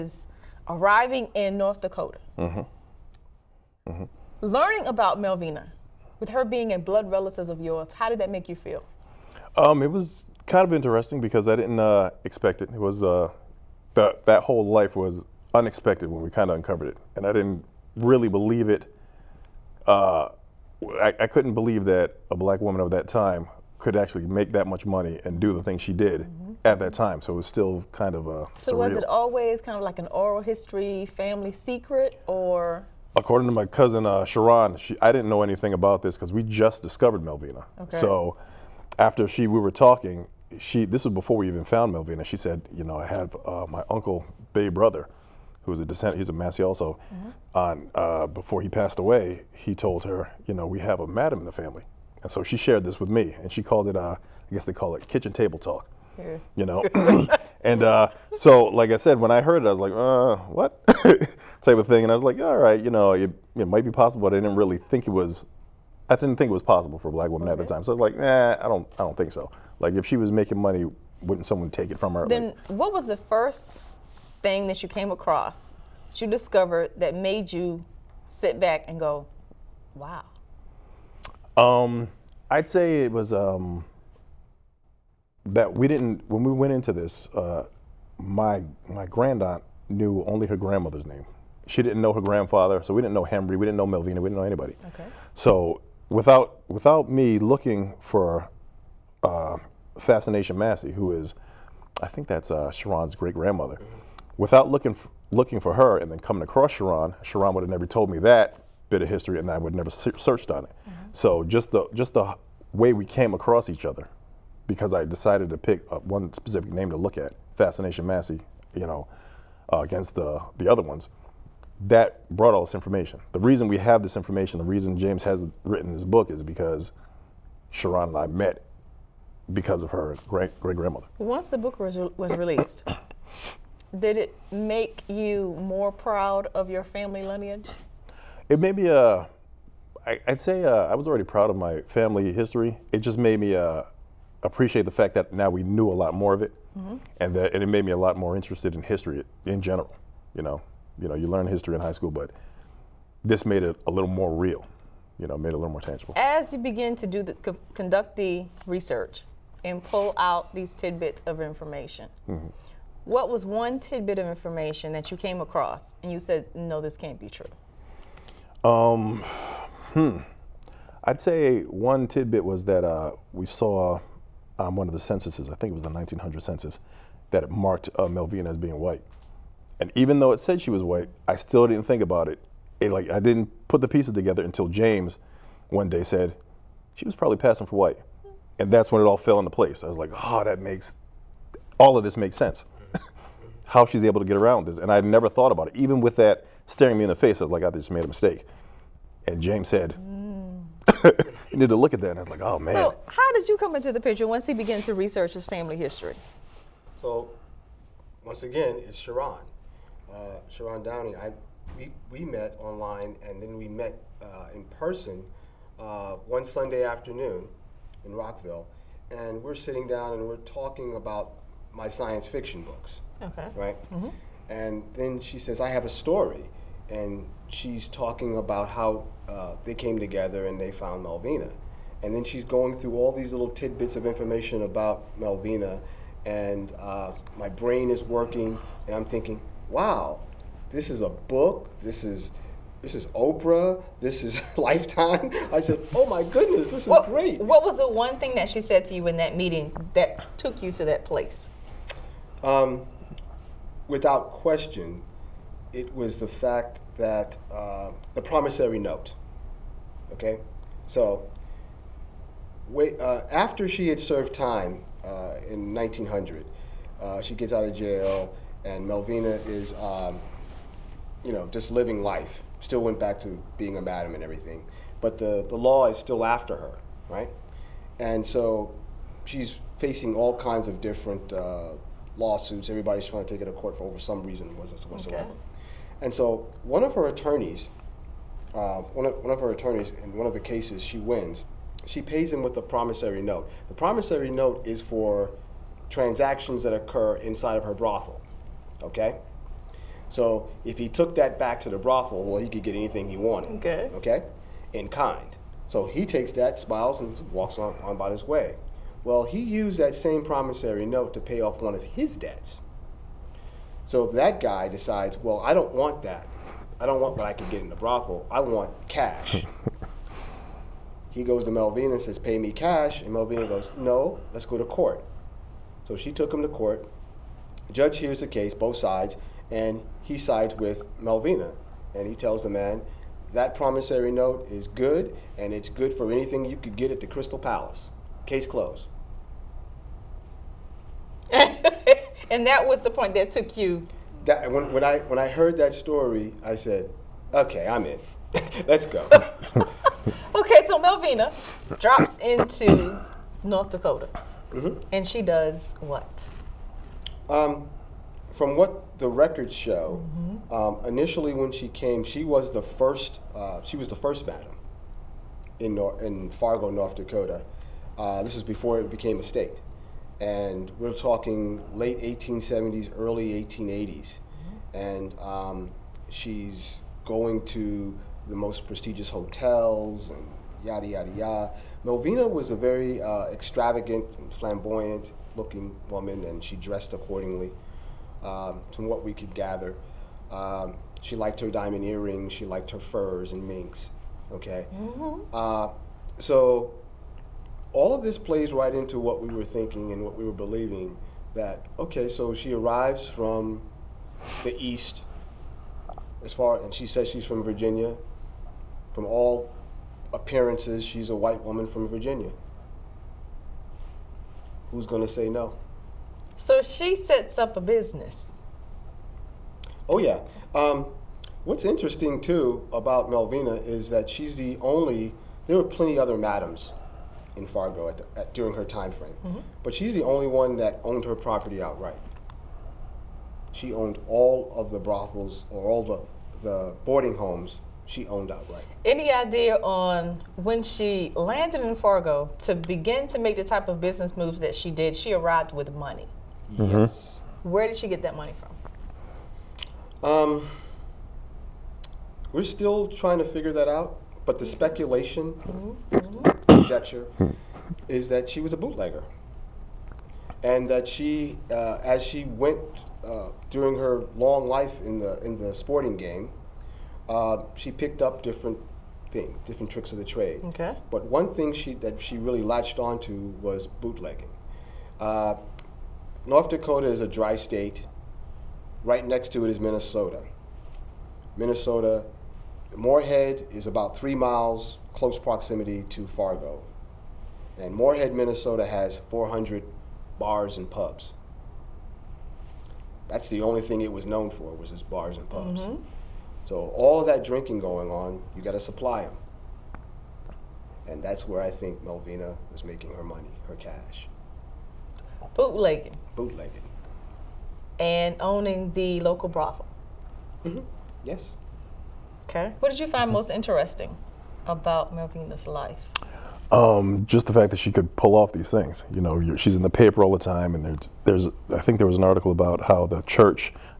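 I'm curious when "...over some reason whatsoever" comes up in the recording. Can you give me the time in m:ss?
4:43.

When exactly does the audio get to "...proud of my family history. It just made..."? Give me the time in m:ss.
2:21.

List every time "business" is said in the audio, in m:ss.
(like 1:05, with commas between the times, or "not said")
6:57, 7:23.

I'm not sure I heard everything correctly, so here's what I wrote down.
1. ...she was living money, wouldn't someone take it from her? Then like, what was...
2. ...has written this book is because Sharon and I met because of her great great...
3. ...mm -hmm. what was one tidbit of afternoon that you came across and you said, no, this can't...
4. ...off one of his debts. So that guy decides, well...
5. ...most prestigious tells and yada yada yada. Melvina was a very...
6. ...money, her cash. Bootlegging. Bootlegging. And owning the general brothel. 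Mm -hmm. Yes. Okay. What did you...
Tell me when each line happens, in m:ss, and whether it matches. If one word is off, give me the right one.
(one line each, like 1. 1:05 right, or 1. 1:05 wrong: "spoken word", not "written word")
1. 1:10 wrong: "making", not "living"
2. 2:05 right
3. 2:42 wrong: "information", not "afternoon"
4. 5:11 right
5. 6:18 wrong: "hotels", not "tells"
6. 8:23 wrong: "local", not "general".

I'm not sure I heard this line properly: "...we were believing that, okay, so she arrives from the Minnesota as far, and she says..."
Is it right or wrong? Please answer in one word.
wrong.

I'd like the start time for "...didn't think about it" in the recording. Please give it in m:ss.
3:01.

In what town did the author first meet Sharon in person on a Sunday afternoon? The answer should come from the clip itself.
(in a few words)
Rockville.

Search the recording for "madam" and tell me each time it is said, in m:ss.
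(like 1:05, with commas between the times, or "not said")
0:51, 4:33, 6:04, 7:06.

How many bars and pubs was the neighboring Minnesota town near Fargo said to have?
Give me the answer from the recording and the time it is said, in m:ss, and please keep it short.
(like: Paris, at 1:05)
400, at 8:09.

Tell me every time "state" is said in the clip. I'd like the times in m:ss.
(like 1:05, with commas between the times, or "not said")
6:09, 7:57.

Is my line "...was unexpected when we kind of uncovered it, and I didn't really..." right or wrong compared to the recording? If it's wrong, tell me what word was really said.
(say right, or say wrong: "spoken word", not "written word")
right.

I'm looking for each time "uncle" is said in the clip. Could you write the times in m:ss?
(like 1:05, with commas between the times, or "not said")
0:43.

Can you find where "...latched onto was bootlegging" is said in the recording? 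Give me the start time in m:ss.
7:52.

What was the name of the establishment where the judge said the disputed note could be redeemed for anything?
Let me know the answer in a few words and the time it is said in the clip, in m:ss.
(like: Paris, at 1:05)
Crystal Palace, at 5:37.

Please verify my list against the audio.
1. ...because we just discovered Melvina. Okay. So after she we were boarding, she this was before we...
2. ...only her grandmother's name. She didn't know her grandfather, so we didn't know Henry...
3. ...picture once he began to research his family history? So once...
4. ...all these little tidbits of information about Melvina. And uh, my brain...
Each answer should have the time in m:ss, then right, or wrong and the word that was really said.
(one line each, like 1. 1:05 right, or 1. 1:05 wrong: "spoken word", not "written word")
1. 0:36 wrong: "talking", not "boarding"
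2. 1:30 right
3. 3:23 right
4. 3:52 right.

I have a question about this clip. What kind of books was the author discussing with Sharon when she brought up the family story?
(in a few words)
science fiction.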